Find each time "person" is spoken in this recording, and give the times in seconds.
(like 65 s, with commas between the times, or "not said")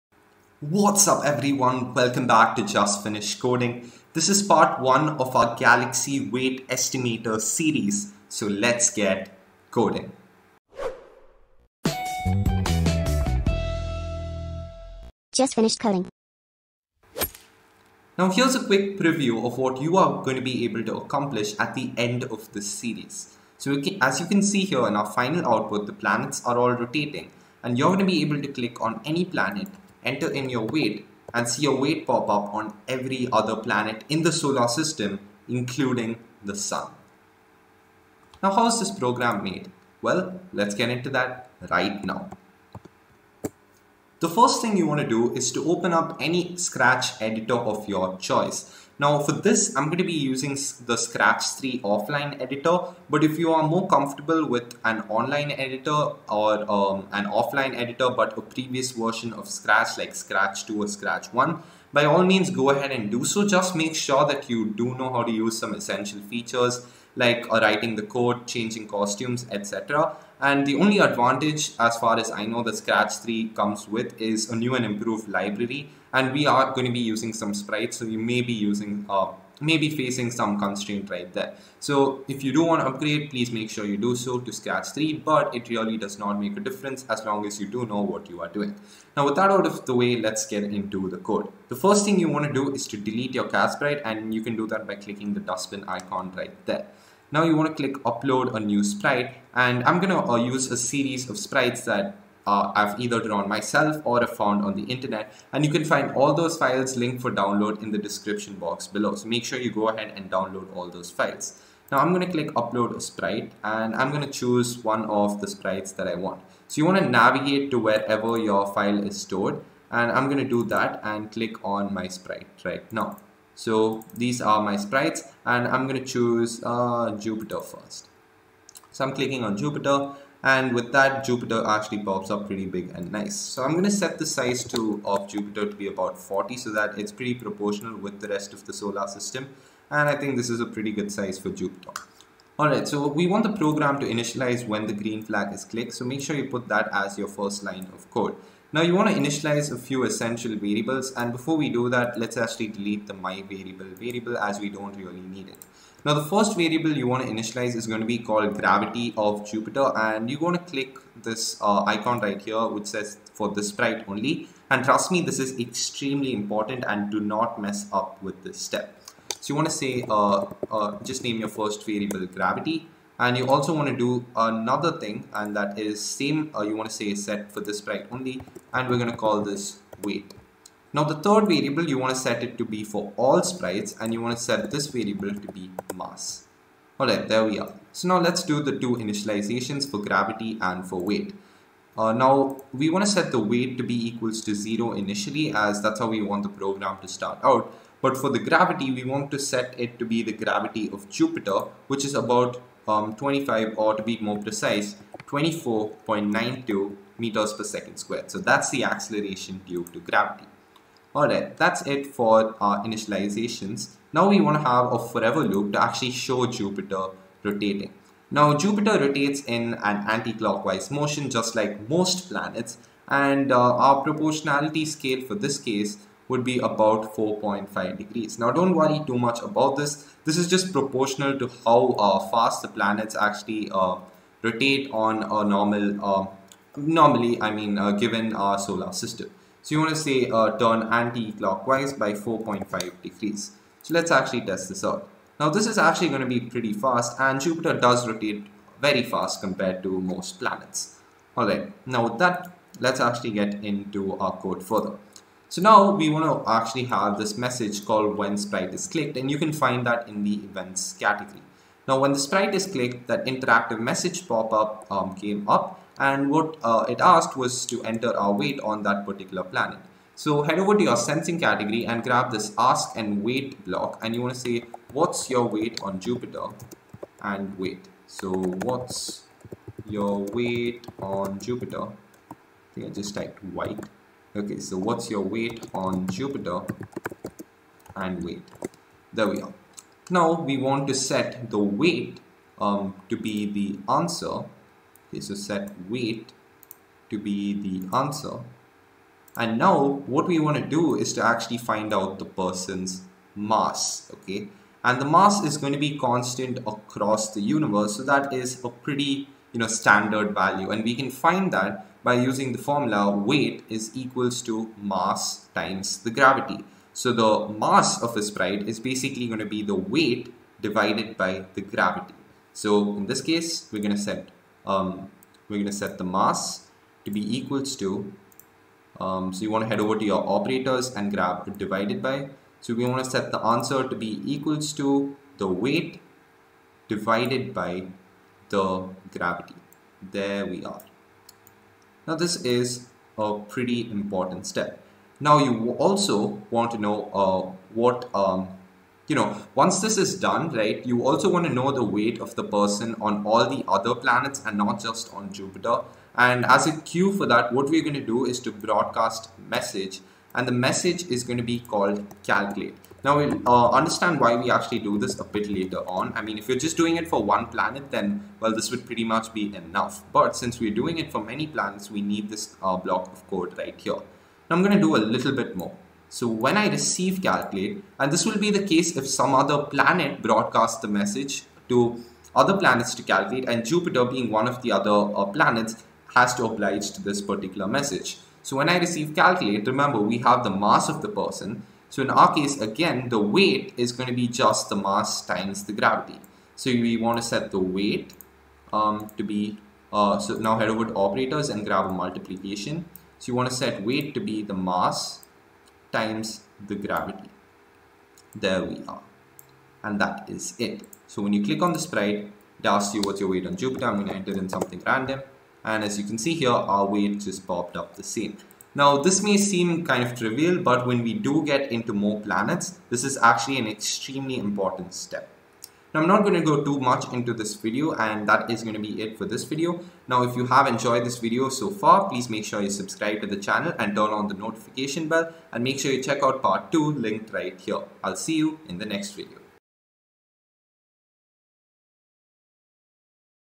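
302 s, 352 s, 391 s.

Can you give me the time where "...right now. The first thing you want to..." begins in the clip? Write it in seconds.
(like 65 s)
41 s.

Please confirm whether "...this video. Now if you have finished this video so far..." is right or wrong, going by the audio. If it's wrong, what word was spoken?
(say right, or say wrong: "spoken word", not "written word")
wrong: "enjoyed", not "finished".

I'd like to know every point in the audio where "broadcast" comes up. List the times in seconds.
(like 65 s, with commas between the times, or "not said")
358 s, 380 s.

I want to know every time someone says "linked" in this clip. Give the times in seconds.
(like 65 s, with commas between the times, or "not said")
106 s, 436 s.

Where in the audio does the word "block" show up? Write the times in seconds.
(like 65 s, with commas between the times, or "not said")
273 s, 372 s.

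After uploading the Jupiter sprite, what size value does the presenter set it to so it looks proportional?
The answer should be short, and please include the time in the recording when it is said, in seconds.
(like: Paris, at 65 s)
40, at 135 s.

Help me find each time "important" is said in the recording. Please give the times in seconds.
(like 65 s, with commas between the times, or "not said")
166 s, 343 s, 424 s.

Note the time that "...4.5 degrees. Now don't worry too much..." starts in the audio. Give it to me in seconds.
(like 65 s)
227 s.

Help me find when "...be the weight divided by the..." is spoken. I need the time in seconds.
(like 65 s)
319 s.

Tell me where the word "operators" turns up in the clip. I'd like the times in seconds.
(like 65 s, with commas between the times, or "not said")
330 s, 400 s.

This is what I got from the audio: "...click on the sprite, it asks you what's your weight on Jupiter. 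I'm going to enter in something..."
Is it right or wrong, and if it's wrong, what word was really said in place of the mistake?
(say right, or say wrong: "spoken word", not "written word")
right.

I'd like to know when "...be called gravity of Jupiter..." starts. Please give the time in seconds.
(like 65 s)
158 s.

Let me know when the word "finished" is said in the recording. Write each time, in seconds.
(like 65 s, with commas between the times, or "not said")
3 s, 15 s.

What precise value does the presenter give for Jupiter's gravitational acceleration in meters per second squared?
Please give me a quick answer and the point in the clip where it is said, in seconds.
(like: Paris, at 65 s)
24.92, at 205 s.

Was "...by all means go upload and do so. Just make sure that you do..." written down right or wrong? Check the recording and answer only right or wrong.
wrong.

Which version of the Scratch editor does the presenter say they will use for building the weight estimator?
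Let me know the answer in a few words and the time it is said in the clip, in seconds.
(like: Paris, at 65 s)
Scratch 3 offline editor, at 50 s.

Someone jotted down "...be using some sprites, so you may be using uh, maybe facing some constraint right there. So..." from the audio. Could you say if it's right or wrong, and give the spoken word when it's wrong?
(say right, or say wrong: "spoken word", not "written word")
right.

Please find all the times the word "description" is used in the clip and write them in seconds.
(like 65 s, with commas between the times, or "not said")
107 s.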